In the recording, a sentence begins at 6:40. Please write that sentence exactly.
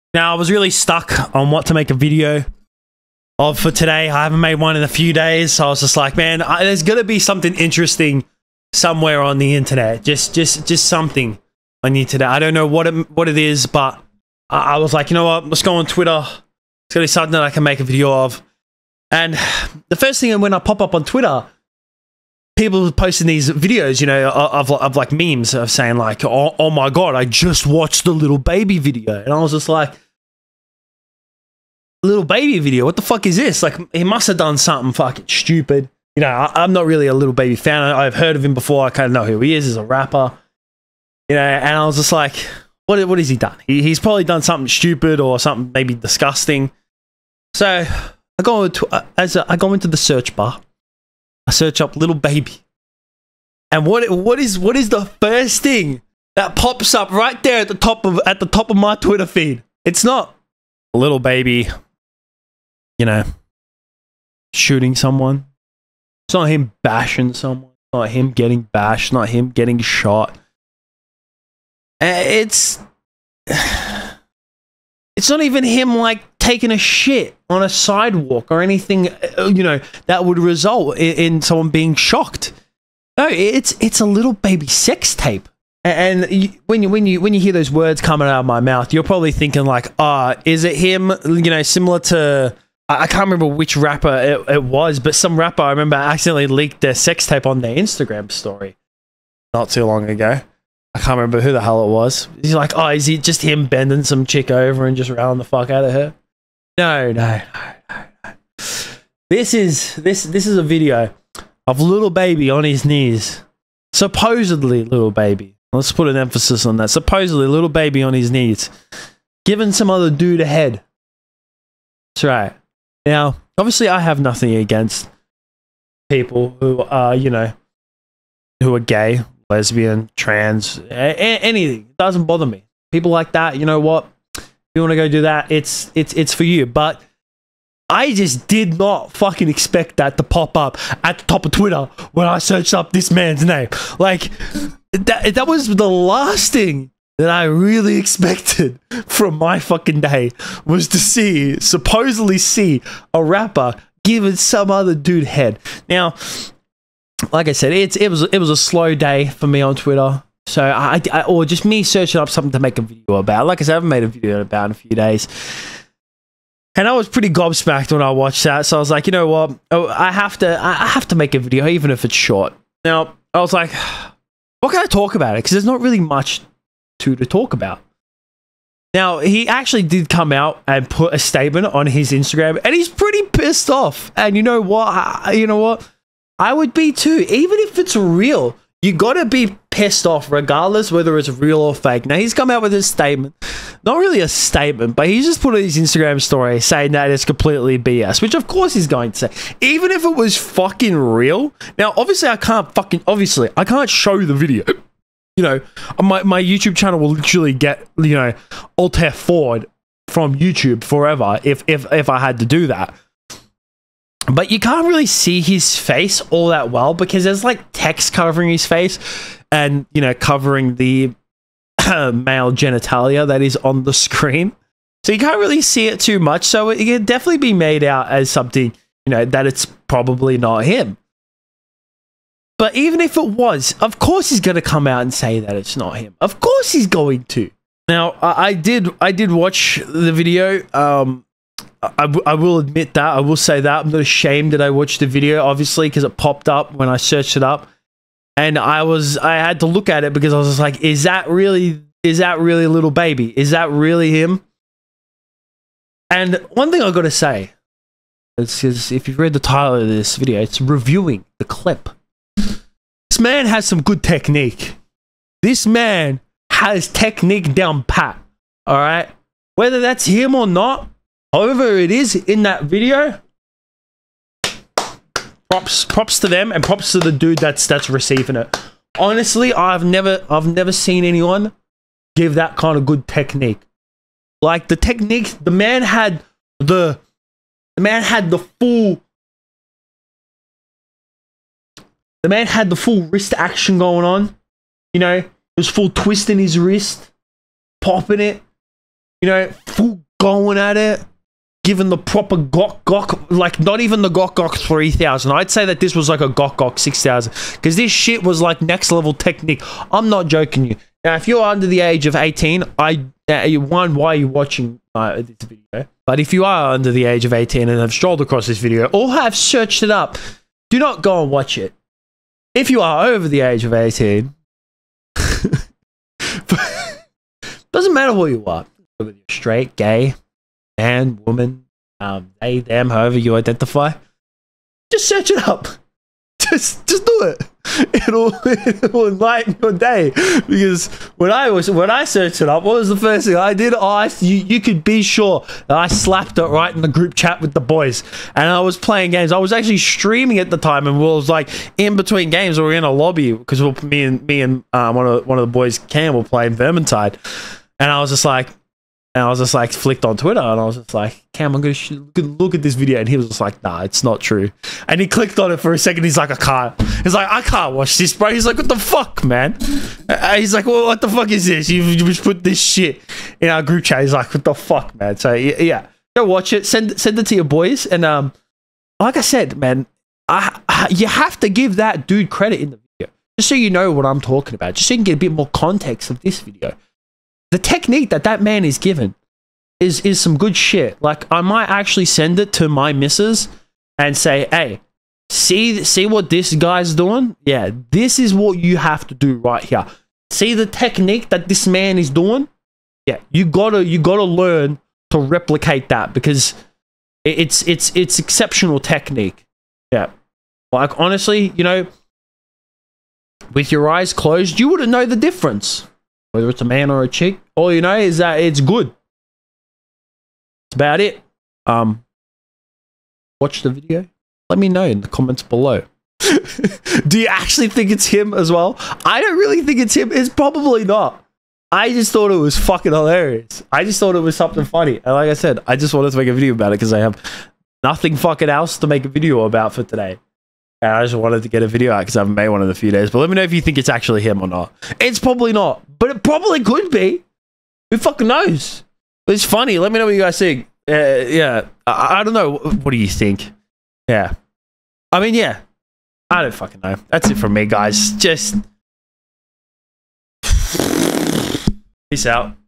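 See the technique that this man is doing?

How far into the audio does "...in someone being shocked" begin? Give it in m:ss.
1:21.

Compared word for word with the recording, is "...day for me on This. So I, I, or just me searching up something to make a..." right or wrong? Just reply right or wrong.
wrong.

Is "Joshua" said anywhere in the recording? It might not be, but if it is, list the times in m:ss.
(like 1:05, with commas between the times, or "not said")
not said.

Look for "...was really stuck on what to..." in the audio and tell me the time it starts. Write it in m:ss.
0:00.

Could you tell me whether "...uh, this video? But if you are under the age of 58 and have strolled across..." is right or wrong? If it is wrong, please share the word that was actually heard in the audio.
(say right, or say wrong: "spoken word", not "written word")
wrong: "18", not "58".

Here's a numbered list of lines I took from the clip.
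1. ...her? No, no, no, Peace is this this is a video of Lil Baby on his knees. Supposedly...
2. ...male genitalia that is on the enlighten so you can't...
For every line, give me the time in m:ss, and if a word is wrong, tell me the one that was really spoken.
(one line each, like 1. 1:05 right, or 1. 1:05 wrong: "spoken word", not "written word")
1. 1:45 wrong: "This", not "Peace"
2. 3:42 wrong: "screen", not "enlighten".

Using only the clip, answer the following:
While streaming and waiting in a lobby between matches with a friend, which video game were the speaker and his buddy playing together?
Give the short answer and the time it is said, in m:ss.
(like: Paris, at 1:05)
Vermintide, at 5:56.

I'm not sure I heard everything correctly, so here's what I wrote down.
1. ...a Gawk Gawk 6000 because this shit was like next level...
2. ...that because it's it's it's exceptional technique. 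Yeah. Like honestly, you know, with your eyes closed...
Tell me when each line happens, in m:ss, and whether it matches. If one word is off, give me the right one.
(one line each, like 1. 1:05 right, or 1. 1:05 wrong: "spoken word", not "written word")
1. 5:06 right
2. 6:45 right.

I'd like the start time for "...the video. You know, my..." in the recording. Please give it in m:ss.
3:24.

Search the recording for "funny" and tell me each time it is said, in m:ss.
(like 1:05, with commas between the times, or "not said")
7:14, 7:29.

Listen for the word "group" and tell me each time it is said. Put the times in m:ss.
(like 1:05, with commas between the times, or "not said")
5:46, 6:13.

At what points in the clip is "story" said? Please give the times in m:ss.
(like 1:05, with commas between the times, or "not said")
1:38, 3:16.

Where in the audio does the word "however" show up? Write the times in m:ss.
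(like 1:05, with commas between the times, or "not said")
4:31, 5:32.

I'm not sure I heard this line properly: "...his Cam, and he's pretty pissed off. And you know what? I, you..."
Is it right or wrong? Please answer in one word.
wrong.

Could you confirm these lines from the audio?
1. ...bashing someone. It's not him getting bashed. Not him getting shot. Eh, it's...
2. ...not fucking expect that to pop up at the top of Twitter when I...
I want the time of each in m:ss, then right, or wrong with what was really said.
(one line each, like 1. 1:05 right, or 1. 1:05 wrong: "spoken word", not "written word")
1. 1:06 right
2. 2:18 right.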